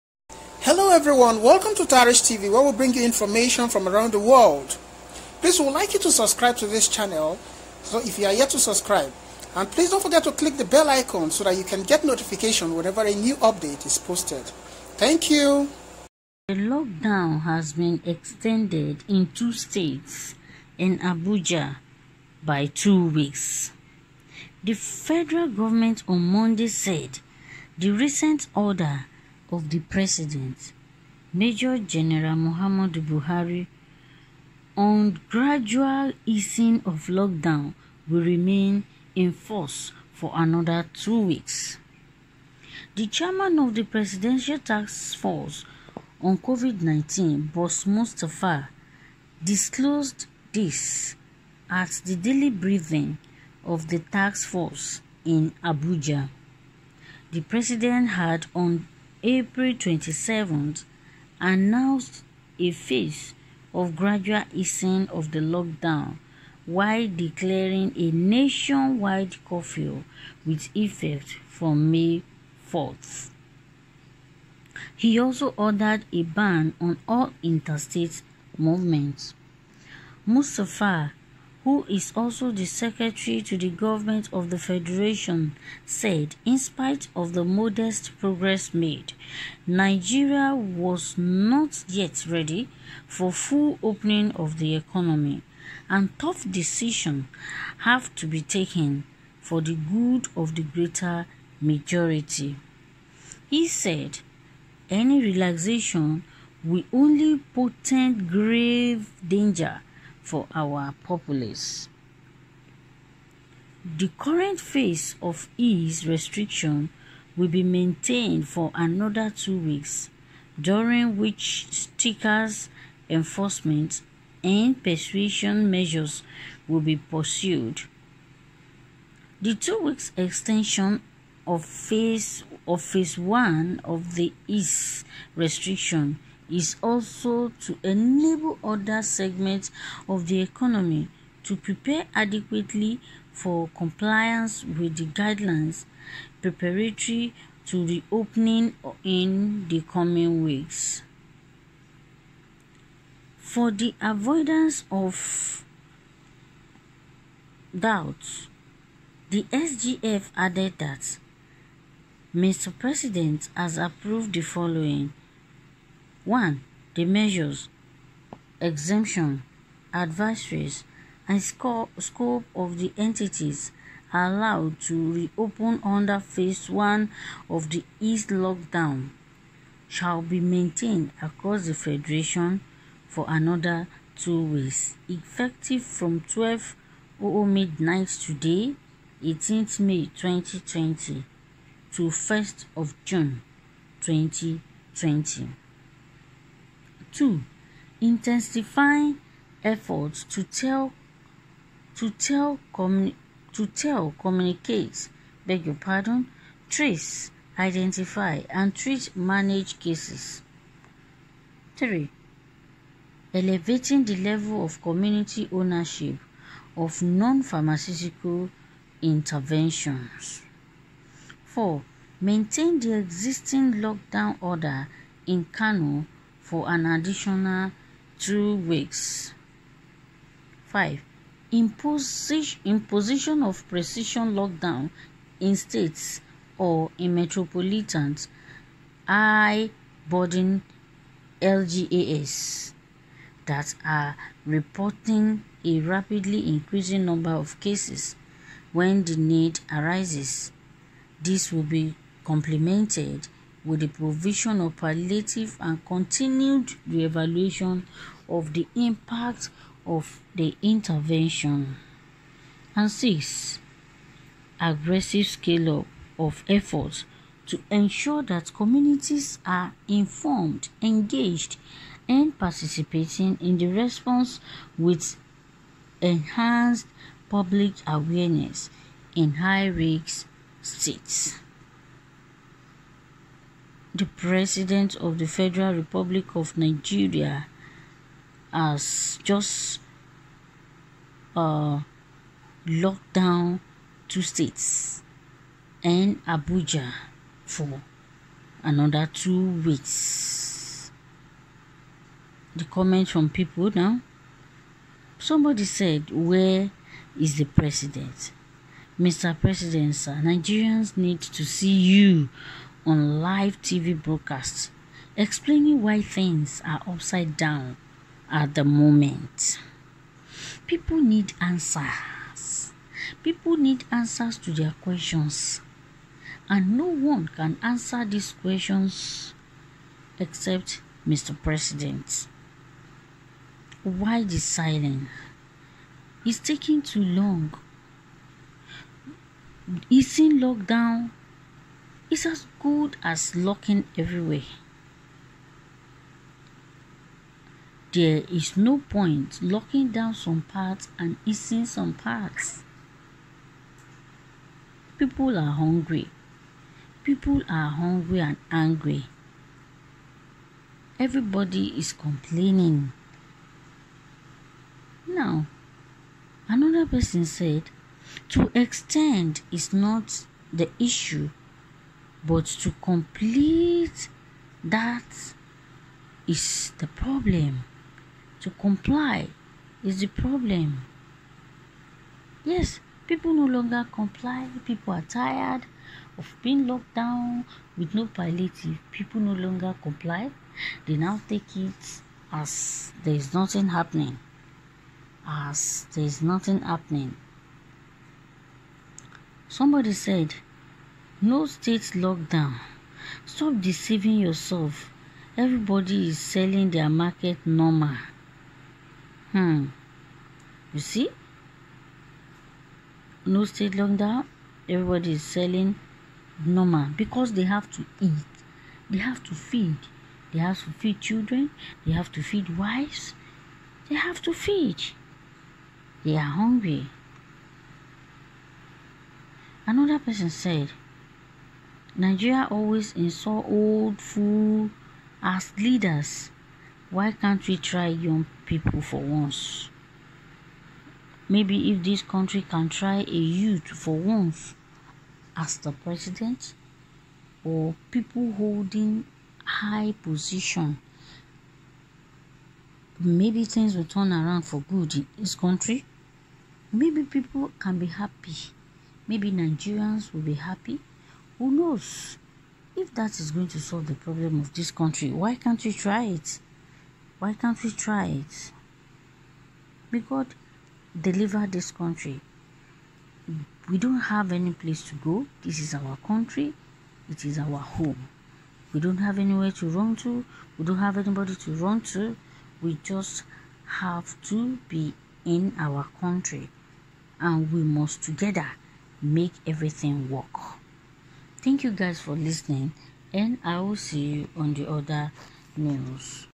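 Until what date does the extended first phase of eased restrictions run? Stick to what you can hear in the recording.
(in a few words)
1 June 2020.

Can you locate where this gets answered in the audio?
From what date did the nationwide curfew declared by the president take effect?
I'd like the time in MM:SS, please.
01:11.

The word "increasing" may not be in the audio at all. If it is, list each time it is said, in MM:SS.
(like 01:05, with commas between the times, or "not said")
04:06.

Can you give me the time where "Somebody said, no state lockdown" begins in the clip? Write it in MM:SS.
06:39.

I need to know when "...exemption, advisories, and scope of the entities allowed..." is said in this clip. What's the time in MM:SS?
02:48.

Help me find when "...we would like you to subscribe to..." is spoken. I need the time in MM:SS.
00:05.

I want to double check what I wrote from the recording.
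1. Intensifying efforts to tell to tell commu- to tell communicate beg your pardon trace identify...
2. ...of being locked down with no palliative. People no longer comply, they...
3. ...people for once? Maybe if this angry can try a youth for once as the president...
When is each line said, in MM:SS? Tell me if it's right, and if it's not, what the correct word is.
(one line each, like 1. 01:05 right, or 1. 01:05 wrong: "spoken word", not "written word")
1. 03:17 right
2. 06:26 right
3. 07:18 wrong: "country", not "angry".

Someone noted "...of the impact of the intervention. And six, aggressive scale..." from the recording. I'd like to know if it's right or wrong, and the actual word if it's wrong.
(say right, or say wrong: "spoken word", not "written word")
right.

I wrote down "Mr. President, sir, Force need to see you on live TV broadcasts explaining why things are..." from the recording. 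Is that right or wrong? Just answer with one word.
wrong.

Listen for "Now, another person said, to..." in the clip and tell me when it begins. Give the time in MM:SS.
06:05.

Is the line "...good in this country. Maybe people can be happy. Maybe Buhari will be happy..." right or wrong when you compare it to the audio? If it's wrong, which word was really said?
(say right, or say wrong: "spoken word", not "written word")
wrong: "Nigerians", not "Buhari".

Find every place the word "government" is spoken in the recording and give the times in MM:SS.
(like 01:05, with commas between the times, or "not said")
00:25, 01:23.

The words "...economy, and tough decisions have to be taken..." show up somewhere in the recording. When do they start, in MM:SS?
01:34.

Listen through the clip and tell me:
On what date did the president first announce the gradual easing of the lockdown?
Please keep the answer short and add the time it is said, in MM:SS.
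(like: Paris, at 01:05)
April 27th, at 00:59.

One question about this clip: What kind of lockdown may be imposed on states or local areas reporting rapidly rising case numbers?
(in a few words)
Precision lockdown.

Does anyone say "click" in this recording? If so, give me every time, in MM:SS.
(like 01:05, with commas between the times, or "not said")
00:10.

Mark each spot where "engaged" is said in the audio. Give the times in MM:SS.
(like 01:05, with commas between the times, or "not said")
04:30.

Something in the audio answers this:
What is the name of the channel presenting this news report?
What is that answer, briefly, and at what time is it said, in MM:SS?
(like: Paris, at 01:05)
Tarich TV, at 00:01.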